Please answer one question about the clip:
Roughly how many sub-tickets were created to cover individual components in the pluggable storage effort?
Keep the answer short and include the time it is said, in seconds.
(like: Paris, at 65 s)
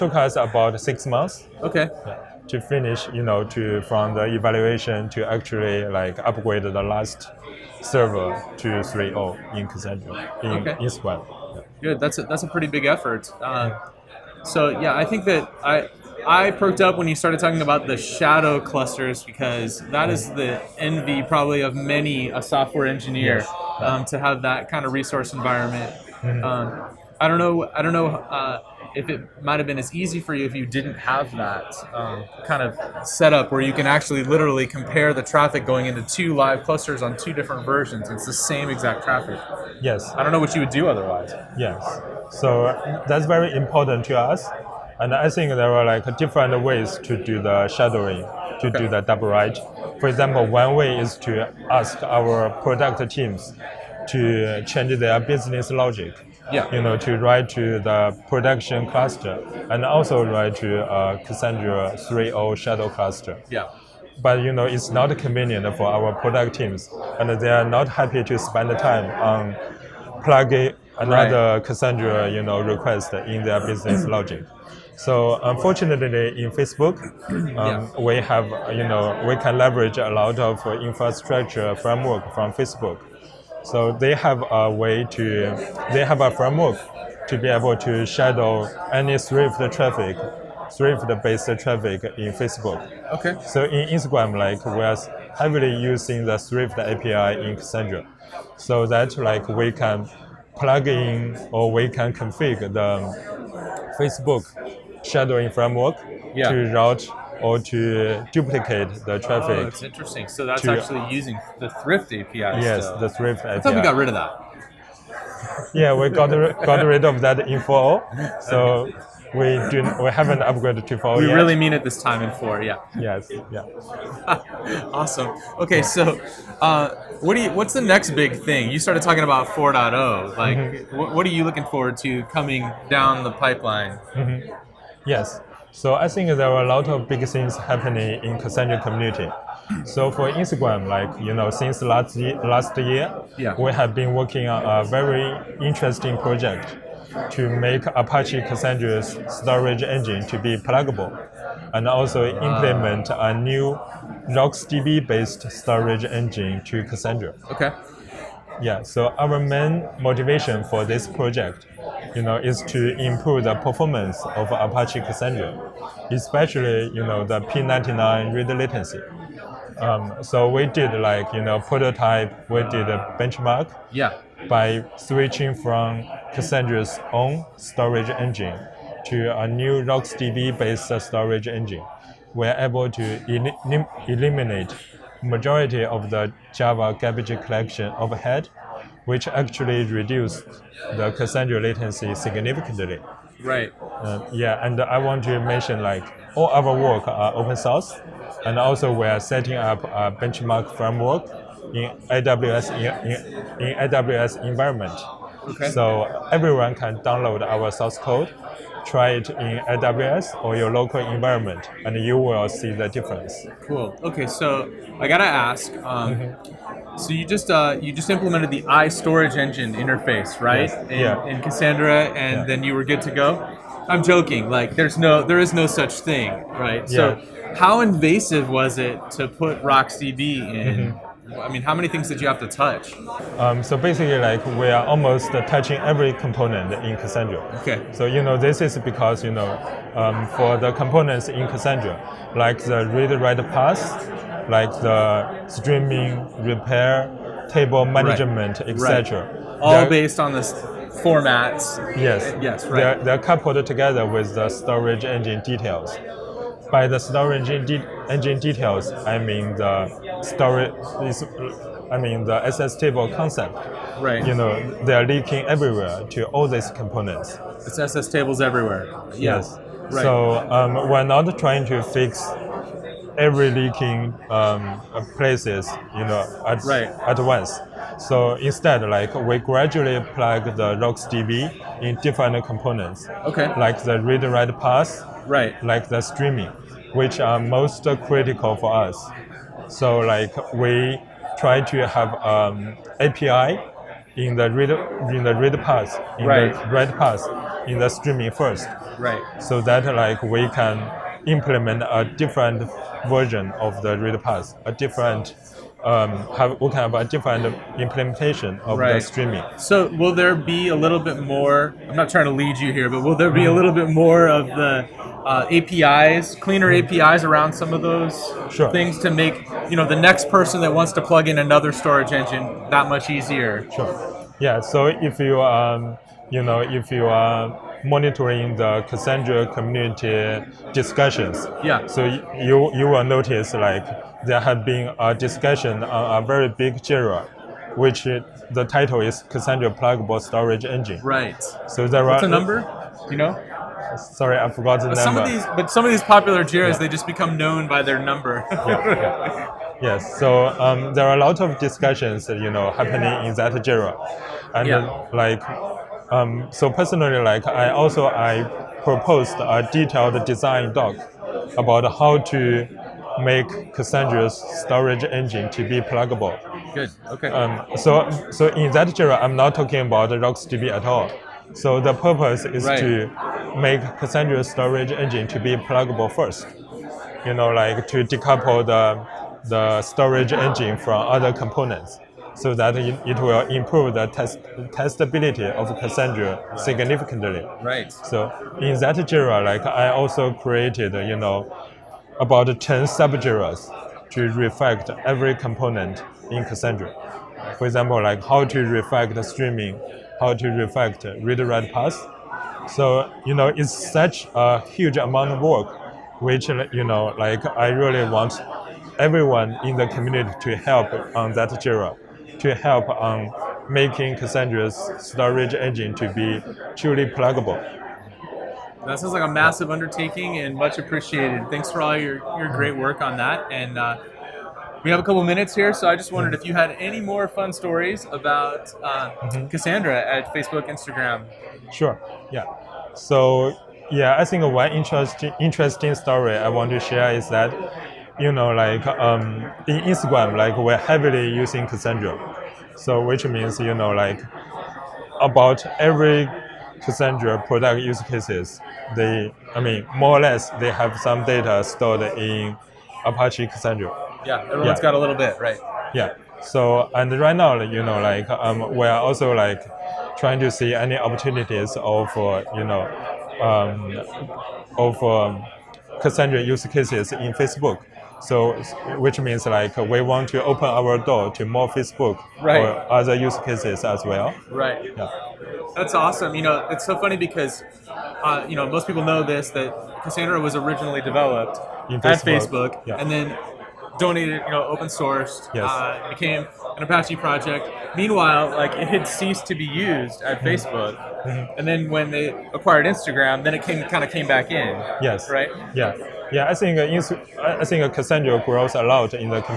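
10, at 392 s.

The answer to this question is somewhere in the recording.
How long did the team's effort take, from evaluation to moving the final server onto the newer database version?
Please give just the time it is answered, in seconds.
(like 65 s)
0 s.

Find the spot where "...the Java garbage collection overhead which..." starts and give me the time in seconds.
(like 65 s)
186 s.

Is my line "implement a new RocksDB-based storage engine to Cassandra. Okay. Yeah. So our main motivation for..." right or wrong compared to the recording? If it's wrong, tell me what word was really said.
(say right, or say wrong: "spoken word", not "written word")
right.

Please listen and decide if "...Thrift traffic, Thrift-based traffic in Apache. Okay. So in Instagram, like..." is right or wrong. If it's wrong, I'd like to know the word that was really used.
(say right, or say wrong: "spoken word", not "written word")
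wrong: "Facebook", not "Apache".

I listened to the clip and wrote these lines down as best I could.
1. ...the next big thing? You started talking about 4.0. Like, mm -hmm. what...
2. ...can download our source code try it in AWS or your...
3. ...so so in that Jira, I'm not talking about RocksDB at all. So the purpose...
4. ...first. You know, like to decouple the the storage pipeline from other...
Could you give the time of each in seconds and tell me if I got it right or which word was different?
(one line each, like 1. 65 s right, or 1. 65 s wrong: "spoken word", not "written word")
1. 127 s right
2. 206 s right
3. 367 s right
4. 376 s wrong: "engine", not "pipeline".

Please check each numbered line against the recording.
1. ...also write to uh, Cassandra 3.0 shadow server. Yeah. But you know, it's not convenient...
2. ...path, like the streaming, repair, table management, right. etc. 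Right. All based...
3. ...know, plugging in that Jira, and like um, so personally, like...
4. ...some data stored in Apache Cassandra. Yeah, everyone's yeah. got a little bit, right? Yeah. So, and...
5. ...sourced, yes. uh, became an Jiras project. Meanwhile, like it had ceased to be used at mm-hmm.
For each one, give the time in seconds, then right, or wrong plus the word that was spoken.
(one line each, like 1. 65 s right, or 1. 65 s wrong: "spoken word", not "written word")
1. 59 s wrong: "cluster", not "server"
2. 243 s right
3. 352 s wrong: "happening", not "plugging"
4. 450 s right
5. 484 s wrong: "Apache", not "Jiras".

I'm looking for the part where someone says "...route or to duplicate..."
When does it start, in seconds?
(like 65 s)
106 s.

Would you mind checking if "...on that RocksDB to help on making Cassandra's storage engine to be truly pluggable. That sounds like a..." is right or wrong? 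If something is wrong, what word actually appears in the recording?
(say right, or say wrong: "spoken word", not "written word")
wrong: "Jira", not "RocksDB".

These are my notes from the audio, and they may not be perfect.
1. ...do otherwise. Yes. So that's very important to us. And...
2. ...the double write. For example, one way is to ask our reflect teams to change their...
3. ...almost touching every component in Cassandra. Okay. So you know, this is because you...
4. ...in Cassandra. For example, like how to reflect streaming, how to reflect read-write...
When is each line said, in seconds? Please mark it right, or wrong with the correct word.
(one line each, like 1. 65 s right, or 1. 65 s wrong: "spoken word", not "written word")
1. 40 s right
2. 48 s wrong: "product", not "reflect"
3. 234 s right
4. 396 s right.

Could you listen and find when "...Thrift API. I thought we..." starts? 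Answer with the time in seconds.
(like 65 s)
113 s.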